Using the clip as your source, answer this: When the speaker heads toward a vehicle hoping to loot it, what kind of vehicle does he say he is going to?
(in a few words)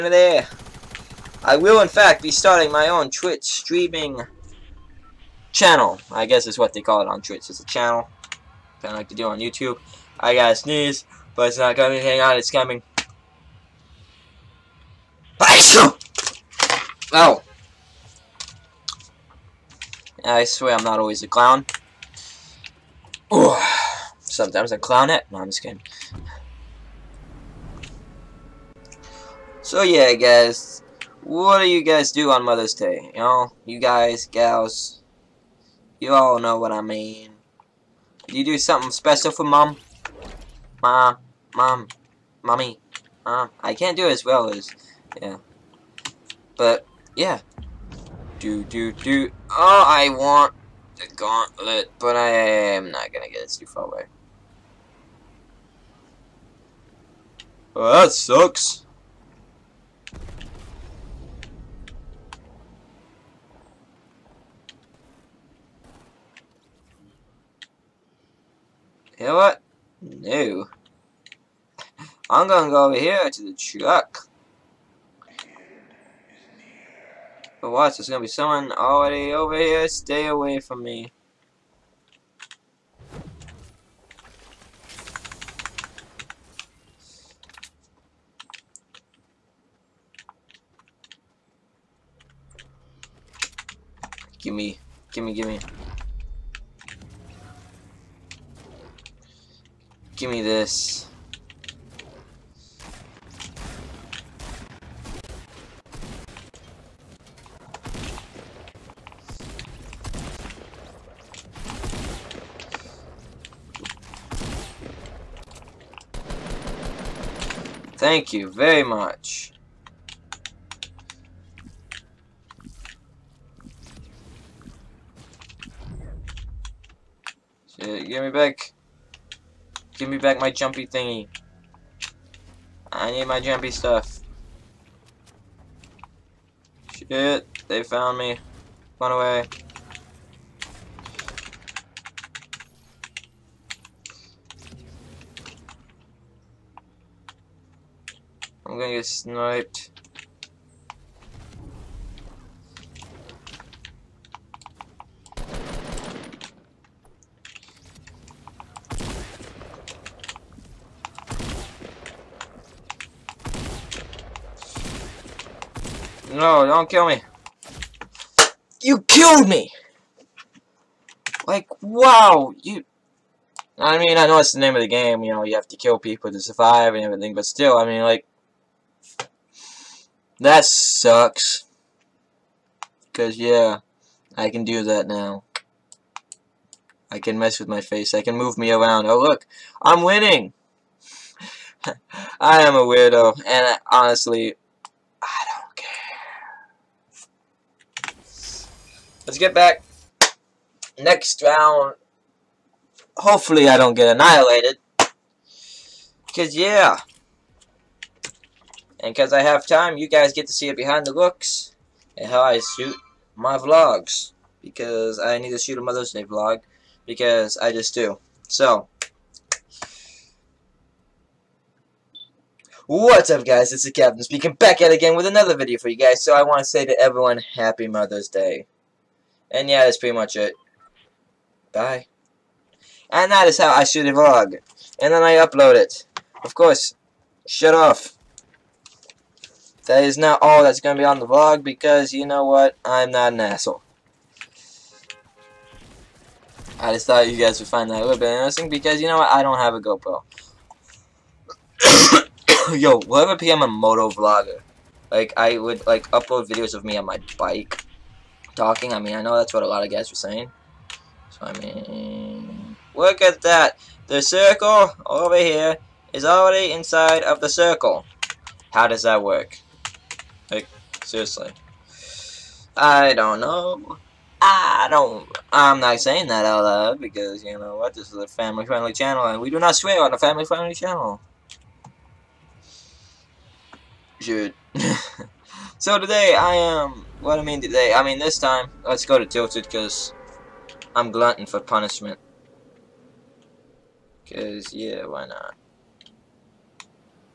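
truck.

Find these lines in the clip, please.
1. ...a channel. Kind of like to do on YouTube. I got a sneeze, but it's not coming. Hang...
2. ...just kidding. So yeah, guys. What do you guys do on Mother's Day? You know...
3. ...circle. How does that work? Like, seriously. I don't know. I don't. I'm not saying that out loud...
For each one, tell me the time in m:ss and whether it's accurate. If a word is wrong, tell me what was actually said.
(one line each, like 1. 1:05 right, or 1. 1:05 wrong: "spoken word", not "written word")
1. 0:07 right
2. 0:25 right
3. 4:27 right.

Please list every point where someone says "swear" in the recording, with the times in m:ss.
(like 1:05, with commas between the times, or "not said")
0:20, 4:39.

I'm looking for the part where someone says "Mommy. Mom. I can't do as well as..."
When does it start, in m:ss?
0:42.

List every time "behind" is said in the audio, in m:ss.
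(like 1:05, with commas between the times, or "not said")
3:30.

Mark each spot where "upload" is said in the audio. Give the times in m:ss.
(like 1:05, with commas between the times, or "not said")
3:55, 4:16.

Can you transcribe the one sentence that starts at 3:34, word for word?
Because I need to shoot a Mother's Day vlog.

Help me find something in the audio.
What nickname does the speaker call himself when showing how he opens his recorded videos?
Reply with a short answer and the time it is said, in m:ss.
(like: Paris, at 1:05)
the Captain, at 3:43.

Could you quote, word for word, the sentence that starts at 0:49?
Oh, I want the gauntlet, but I am not gonna get it too far away.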